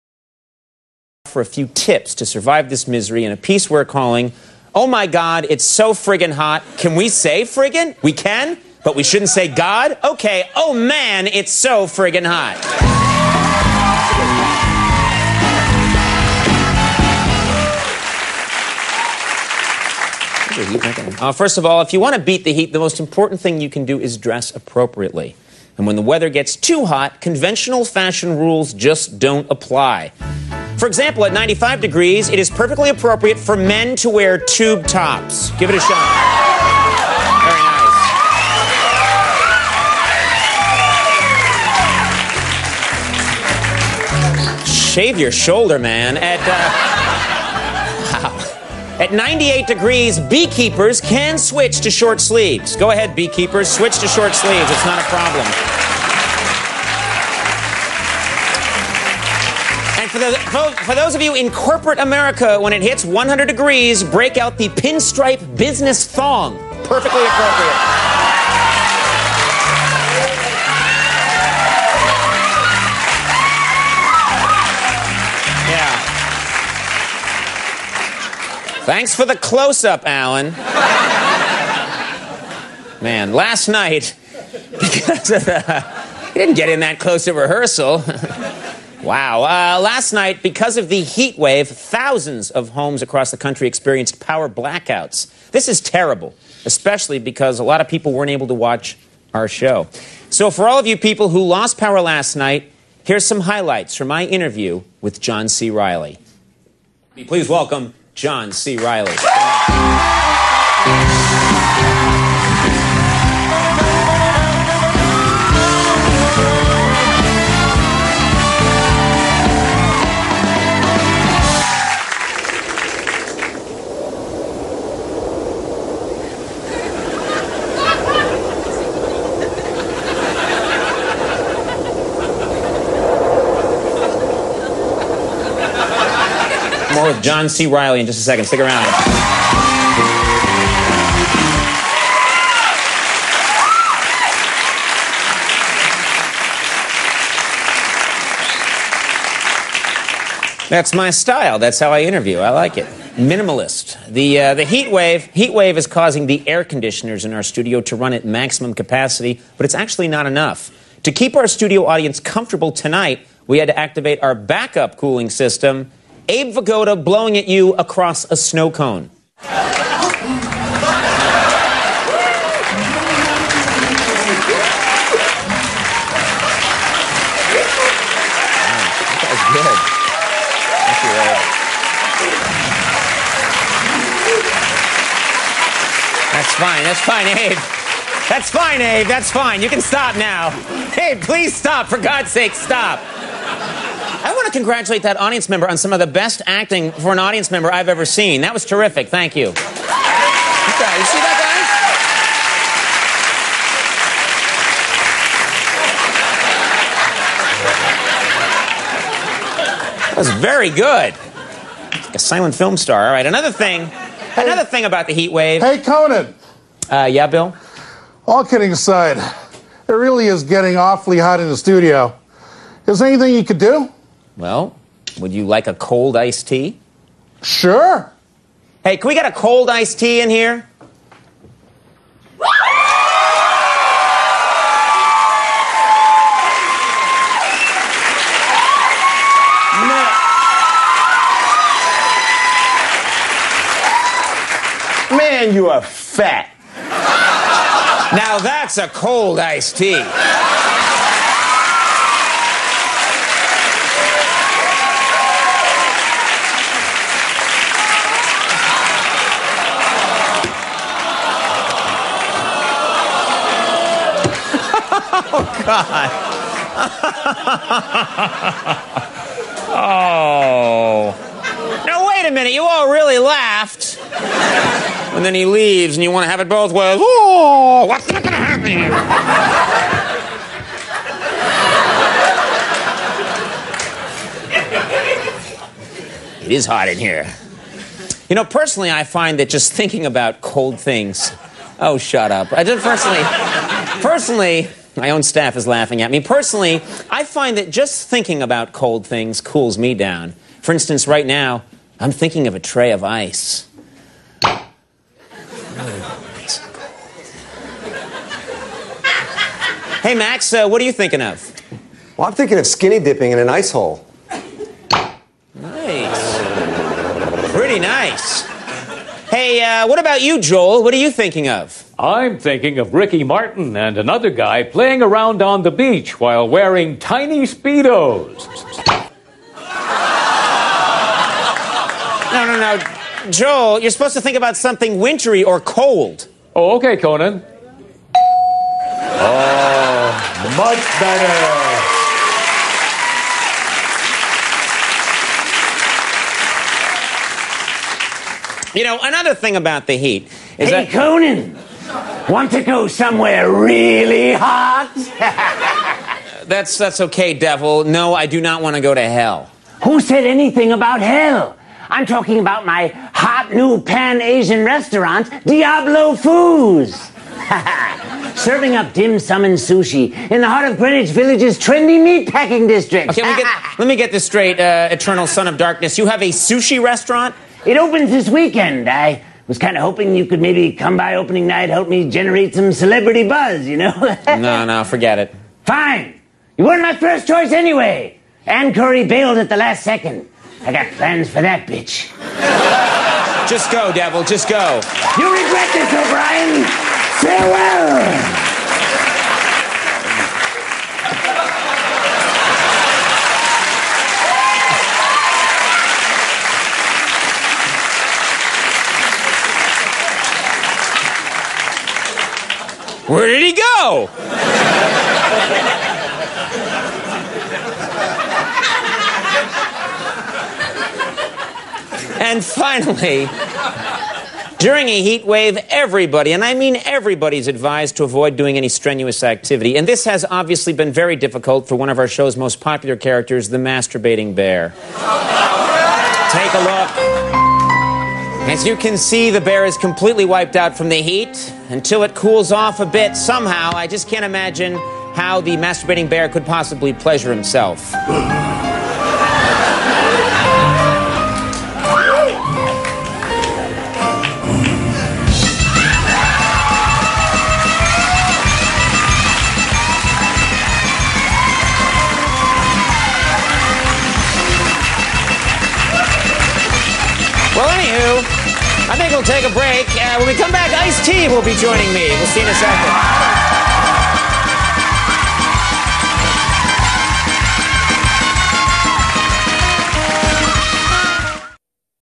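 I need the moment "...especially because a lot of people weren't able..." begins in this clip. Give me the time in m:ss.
1:36.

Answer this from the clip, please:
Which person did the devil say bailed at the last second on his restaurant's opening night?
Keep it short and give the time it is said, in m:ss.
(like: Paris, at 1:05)
Ann Curry, at 6:28.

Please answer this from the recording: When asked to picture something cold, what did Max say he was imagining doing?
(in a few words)
Skinny dipping in an ice hole.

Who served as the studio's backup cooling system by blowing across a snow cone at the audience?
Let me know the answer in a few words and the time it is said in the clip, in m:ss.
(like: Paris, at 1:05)
Abe Vigoda, at 2:46.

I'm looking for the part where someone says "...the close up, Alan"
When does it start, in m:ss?
1:19.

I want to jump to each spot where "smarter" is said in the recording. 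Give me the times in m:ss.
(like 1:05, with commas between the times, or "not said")
not said.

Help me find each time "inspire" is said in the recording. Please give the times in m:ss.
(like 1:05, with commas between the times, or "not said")
not said.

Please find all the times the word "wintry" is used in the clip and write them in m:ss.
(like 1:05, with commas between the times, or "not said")
5:34.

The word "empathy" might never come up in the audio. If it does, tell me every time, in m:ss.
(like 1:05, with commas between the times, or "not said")
not said.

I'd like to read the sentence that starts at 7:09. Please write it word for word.
And this has obviously been very difficult for one of our show's most popular characters, the masturbating bear.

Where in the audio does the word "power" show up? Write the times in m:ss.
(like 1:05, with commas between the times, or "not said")
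1:34, 1:41.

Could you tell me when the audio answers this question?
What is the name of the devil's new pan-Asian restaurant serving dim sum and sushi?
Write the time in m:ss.
6:05.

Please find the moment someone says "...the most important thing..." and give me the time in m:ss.
0:22.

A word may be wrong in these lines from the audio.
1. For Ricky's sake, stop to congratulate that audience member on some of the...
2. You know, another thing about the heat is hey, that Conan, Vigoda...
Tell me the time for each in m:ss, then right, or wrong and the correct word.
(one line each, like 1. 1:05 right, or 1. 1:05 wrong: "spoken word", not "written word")
1. 3:11 wrong: "God", not "Ricky"
2. 5:48 wrong: "Want", not "Vigoda".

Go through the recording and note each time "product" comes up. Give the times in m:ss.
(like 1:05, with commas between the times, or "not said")
not said.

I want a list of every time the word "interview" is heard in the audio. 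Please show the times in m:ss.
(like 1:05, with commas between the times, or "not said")
1:44, 2:32.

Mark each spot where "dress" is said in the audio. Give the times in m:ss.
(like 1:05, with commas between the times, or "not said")
0:24.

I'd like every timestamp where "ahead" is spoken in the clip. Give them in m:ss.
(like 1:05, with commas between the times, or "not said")
0:52.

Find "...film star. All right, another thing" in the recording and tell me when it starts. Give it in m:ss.
3:32.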